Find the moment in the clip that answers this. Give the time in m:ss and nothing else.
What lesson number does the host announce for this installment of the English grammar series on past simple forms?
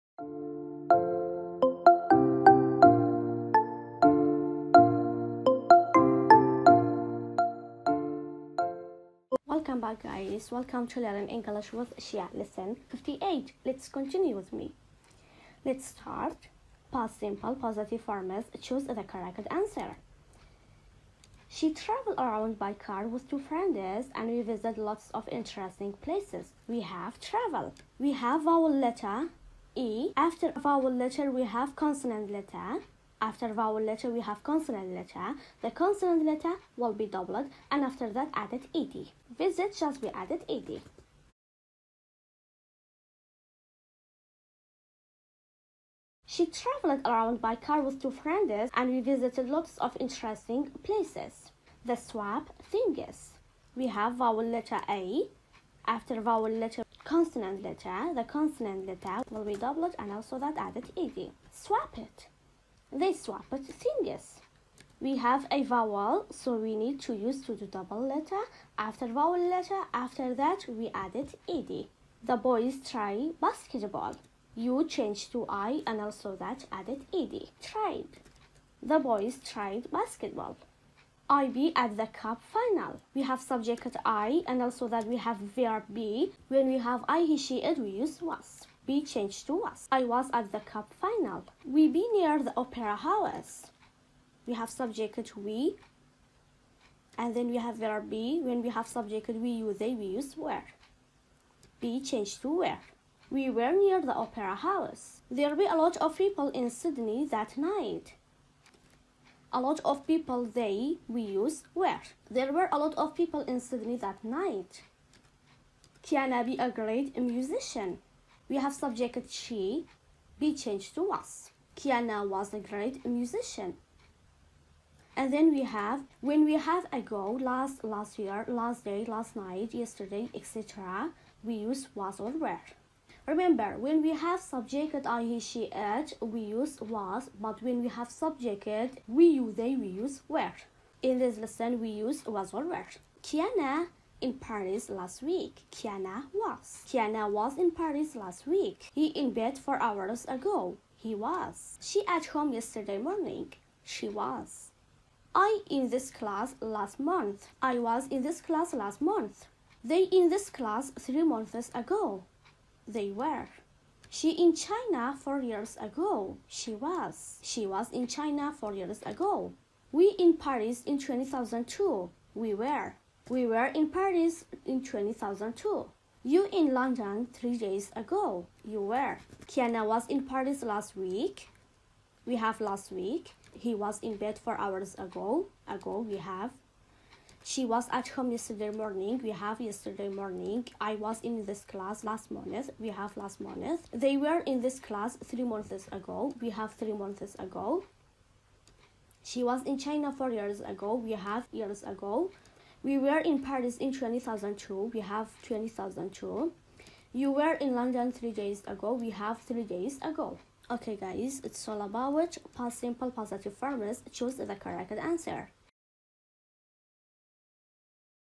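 0:12.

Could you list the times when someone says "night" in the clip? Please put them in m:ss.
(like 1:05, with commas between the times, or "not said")
1:47, 1:54, 2:09.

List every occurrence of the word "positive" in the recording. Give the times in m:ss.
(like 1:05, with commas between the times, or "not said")
0:17, 3:33.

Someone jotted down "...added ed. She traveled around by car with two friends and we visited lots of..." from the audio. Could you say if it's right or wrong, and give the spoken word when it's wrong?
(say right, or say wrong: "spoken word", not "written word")
right.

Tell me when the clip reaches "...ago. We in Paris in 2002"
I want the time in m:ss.
2:49.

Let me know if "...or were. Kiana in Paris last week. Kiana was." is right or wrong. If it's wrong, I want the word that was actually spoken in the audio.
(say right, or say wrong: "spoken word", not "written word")
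right.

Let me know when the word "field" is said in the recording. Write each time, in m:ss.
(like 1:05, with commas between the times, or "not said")
not said.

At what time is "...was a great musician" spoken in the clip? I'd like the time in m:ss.
2:02.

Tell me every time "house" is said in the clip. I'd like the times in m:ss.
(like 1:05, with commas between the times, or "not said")
1:32, 1:44.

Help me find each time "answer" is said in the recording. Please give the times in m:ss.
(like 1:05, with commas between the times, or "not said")
0:19, 3:34.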